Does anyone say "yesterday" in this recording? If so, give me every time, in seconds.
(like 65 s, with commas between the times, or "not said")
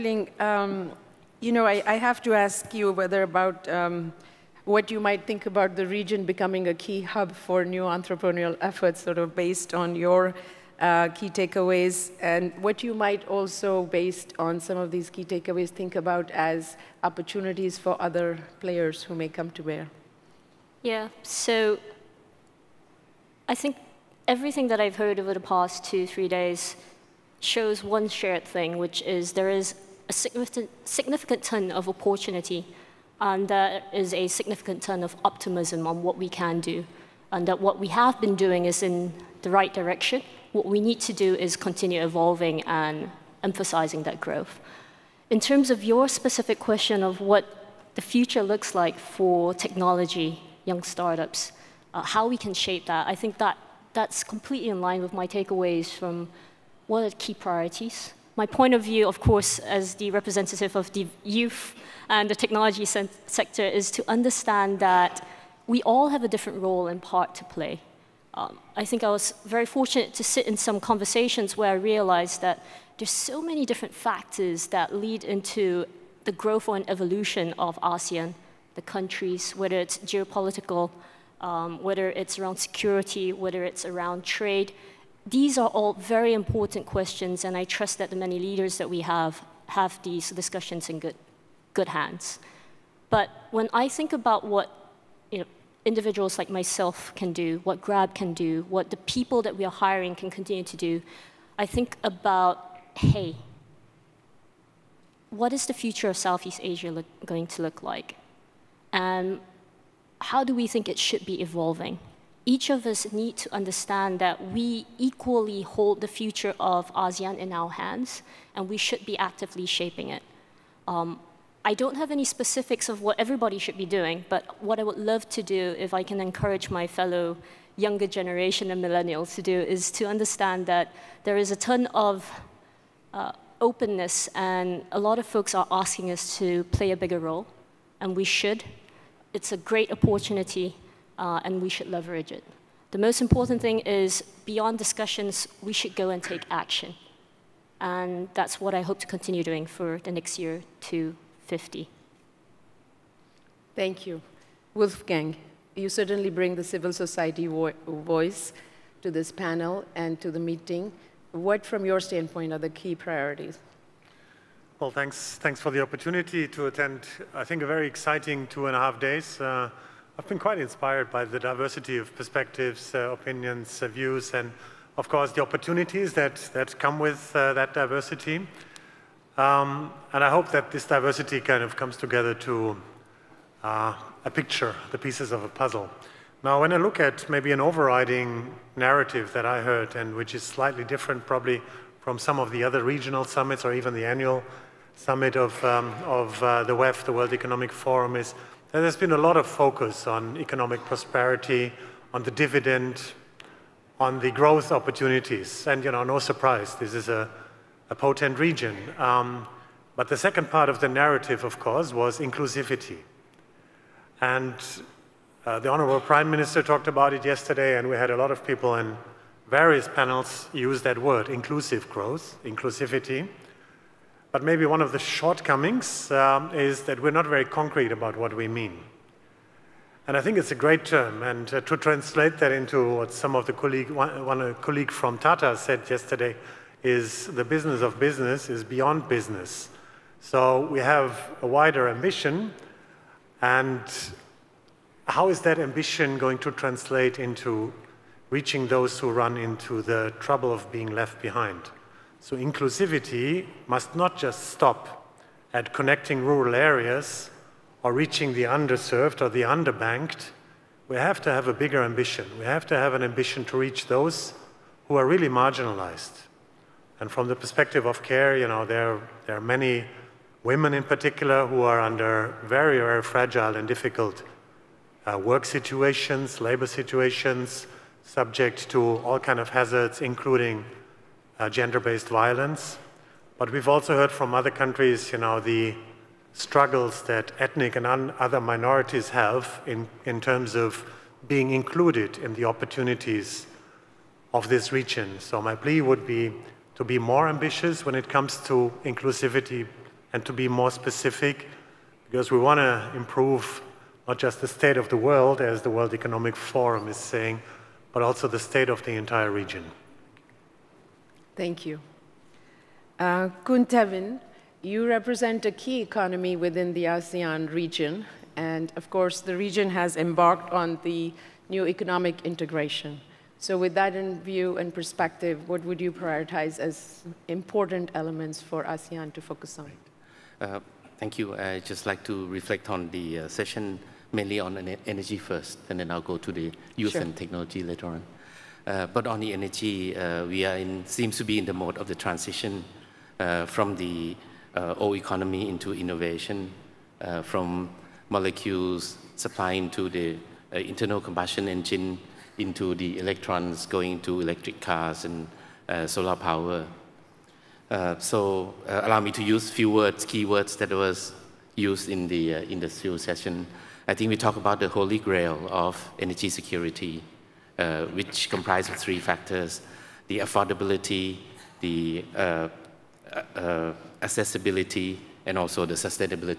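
217 s, 235 s.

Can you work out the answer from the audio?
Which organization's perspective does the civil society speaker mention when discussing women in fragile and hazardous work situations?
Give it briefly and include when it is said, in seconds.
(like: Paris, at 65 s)
CARE, at 268 s.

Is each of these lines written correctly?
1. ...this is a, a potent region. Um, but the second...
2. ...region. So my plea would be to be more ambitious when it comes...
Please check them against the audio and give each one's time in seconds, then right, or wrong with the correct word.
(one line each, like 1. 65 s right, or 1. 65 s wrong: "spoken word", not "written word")
1. 206 s right
2. 294 s right.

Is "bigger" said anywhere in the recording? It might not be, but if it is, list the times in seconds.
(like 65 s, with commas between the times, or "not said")
136 s, 261 s.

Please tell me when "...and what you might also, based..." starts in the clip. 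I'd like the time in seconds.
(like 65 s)
12 s.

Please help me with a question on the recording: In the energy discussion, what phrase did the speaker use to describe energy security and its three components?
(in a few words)
holy grail.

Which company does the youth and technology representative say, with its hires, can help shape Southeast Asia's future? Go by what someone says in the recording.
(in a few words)
Grab.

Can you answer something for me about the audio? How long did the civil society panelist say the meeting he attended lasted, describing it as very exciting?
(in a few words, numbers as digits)
two and a half days.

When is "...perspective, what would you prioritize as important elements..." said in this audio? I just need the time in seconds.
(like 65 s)
324 s.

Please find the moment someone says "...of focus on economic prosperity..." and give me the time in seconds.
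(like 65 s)
199 s.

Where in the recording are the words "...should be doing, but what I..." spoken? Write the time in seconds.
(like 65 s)
123 s.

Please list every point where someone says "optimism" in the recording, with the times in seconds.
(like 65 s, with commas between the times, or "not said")
35 s.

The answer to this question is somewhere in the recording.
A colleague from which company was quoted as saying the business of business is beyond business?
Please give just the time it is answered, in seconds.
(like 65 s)
235 s.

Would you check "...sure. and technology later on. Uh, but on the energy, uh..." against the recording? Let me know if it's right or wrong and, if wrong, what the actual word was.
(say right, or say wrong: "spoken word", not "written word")
right.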